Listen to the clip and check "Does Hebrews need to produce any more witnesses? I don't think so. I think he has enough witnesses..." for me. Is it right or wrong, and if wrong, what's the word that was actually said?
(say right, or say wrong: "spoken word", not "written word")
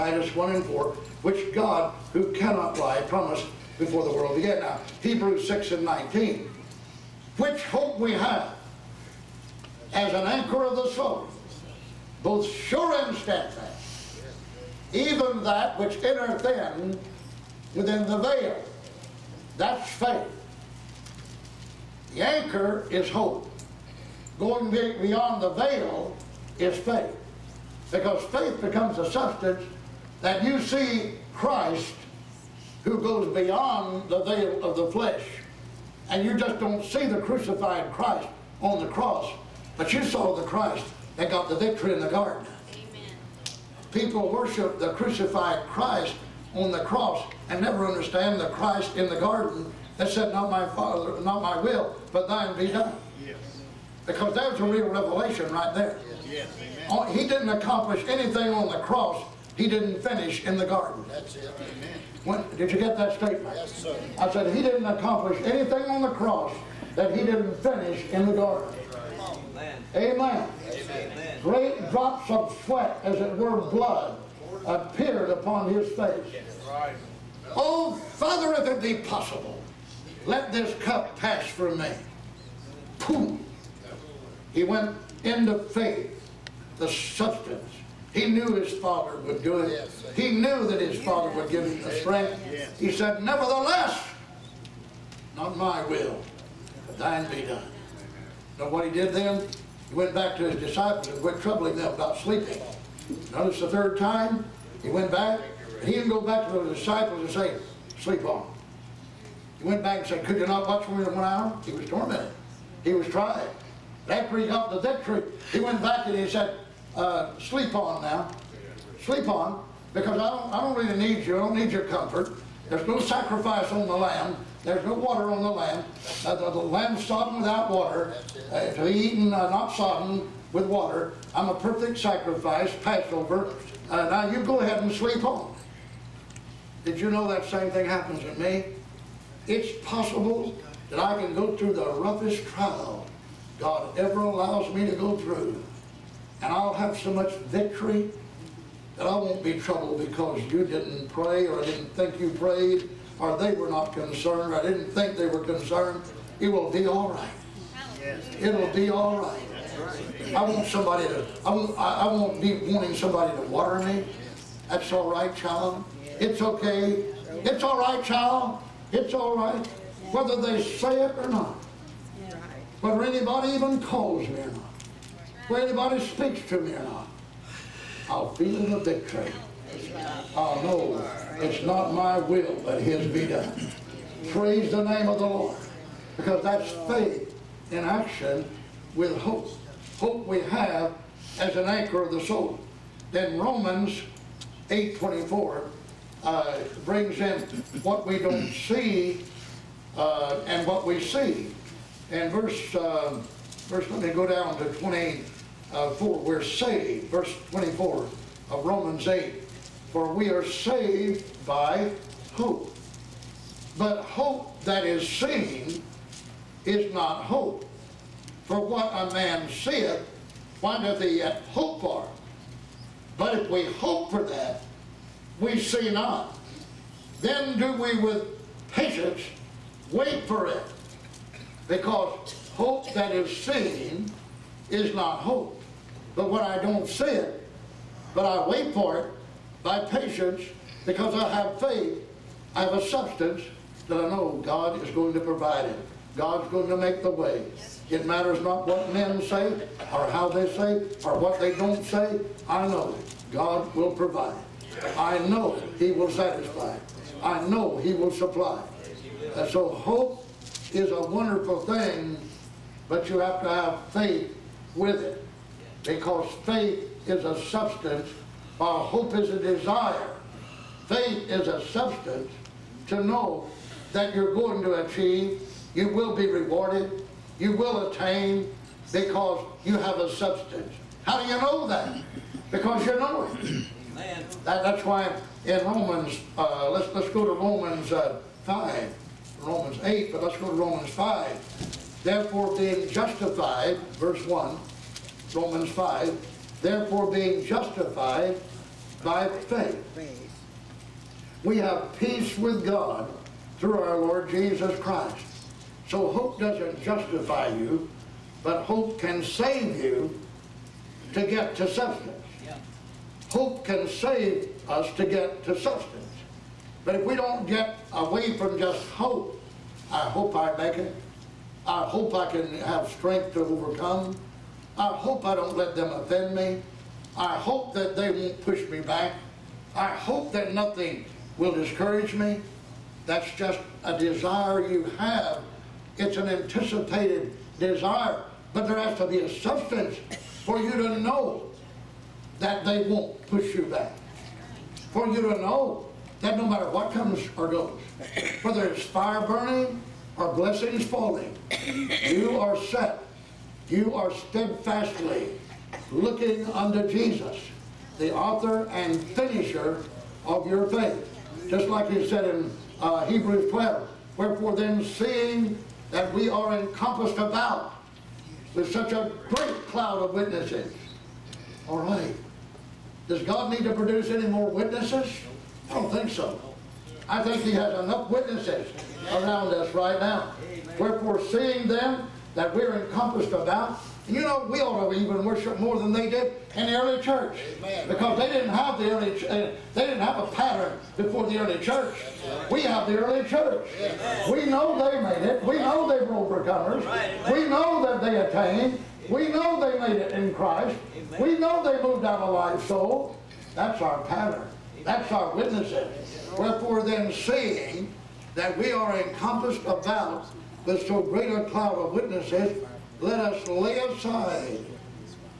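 wrong: "God", not "Hebrews".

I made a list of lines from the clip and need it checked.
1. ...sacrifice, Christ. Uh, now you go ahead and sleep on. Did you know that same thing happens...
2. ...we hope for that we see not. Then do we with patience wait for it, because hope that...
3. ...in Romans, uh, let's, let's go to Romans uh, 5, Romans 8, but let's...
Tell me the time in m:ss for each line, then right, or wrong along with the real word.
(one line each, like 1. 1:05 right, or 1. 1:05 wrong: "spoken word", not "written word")
1. 2:11 wrong: "Passover", not "Christ"
2. 3:43 right
3. 4:45 right.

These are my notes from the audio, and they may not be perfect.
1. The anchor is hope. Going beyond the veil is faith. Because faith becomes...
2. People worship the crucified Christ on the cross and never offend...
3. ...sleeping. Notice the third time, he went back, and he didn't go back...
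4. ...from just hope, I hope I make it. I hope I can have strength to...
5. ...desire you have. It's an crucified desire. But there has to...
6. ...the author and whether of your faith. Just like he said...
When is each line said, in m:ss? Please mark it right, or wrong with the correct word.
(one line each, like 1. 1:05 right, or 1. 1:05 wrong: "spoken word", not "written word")
1. 0:22 right
2. 0:43 wrong: "understand", not "offend"
3. 1:42 right
4. 5:18 right
5. 5:33 wrong: "anticipated", not "crucified"
6. 5:57 wrong: "finisher", not "whether".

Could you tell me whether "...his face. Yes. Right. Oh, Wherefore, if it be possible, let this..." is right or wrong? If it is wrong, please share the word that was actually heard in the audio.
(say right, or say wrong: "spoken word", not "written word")
wrong: "Father", not "Wherefore".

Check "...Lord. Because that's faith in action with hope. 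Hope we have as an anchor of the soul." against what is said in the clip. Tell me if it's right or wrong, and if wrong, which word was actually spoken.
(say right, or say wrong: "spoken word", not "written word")
right.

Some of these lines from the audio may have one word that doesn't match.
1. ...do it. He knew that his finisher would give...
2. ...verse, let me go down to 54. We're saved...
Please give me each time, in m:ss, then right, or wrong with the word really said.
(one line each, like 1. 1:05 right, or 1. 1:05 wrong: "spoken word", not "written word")
1. 1:29 wrong: "father", not "finisher"
2. 3:23 wrong: "24", not "54".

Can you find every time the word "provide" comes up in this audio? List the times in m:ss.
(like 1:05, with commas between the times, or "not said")
4:05, 4:13.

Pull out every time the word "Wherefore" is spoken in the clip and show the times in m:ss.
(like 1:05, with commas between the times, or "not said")
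6:04, 6:20, 6:46.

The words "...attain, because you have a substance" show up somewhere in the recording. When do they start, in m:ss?
4:37.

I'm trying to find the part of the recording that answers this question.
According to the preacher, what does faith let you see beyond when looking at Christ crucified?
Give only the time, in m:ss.
0:34.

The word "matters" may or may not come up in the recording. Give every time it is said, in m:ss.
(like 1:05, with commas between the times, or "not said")
4:08, 5:46.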